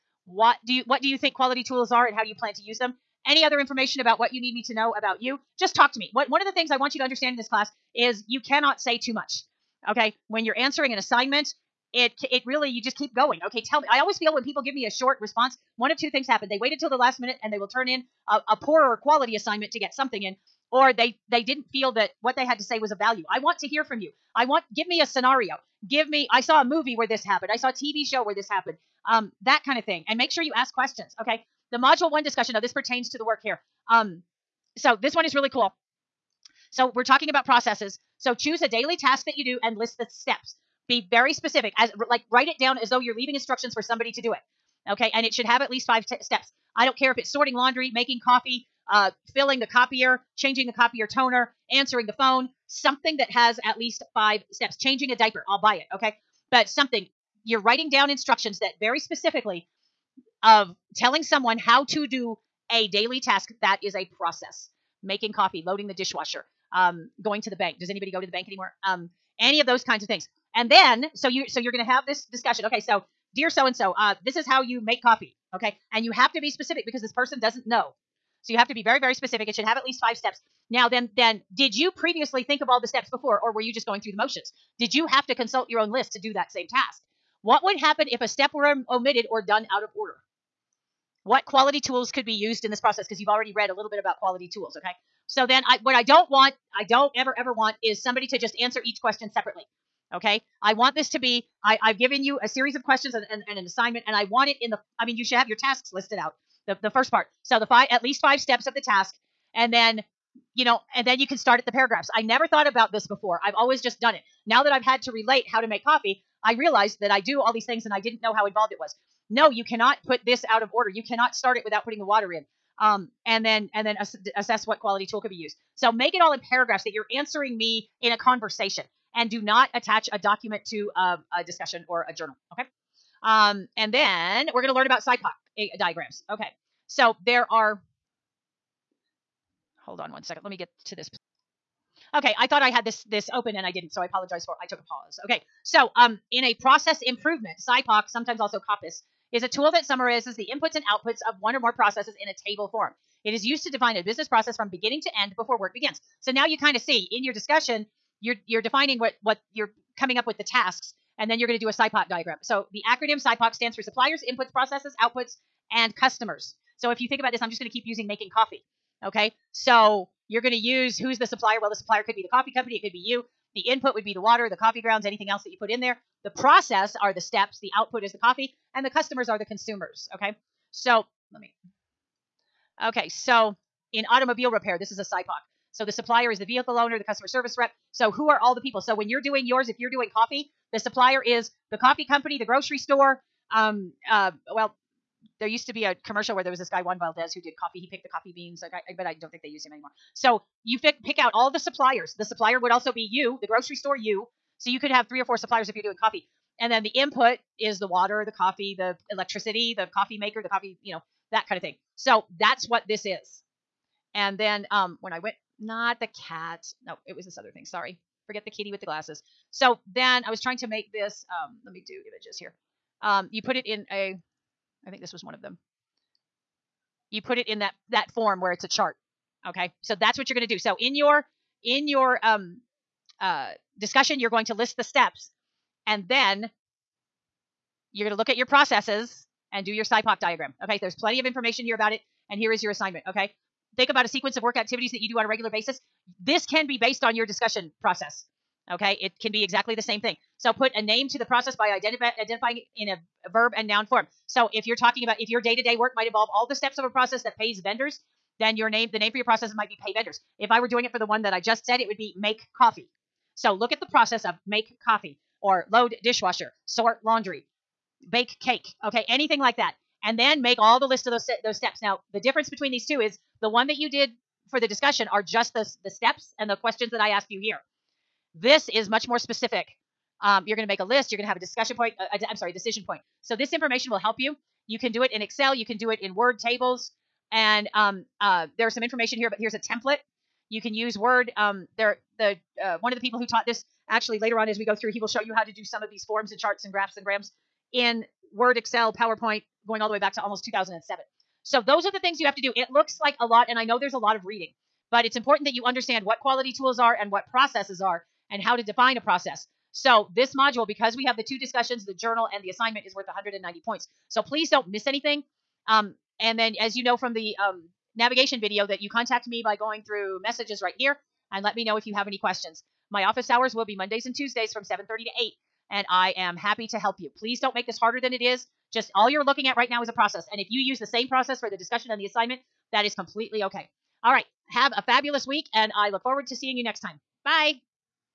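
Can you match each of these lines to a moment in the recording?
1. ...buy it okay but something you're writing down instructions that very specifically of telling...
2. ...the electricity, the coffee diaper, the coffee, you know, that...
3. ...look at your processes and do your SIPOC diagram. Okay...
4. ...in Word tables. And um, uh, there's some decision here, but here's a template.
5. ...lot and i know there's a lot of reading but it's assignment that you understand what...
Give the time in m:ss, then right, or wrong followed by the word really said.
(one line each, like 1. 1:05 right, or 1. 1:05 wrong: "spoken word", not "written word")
1. 0:55 right
2. 3:28 wrong: "maker", not "diaper"
3. 3:58 right
4. 4:46 wrong: "information", not "decision"
5. 5:03 wrong: "important", not "assignment".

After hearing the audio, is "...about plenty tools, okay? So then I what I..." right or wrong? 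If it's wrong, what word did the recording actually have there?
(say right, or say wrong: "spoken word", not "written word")
wrong: "quality", not "plenty".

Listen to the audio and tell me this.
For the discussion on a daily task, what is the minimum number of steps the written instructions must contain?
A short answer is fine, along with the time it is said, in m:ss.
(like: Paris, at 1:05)
5, at 0:45.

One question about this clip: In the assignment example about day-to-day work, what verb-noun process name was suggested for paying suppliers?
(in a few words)
Pay vendors.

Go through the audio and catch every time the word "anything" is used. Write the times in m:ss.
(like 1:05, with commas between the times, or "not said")
2:55, 4:29, 5:14.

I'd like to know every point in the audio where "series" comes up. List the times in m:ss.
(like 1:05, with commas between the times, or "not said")
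1:42.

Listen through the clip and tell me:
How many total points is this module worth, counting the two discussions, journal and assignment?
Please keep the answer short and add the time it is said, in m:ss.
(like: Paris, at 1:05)
190, at 5:13.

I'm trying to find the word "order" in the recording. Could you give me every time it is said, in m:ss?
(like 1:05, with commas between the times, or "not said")
1:29, 2:00.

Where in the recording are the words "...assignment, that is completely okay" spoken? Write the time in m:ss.
5:32.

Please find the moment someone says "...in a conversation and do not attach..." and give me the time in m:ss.
2:08.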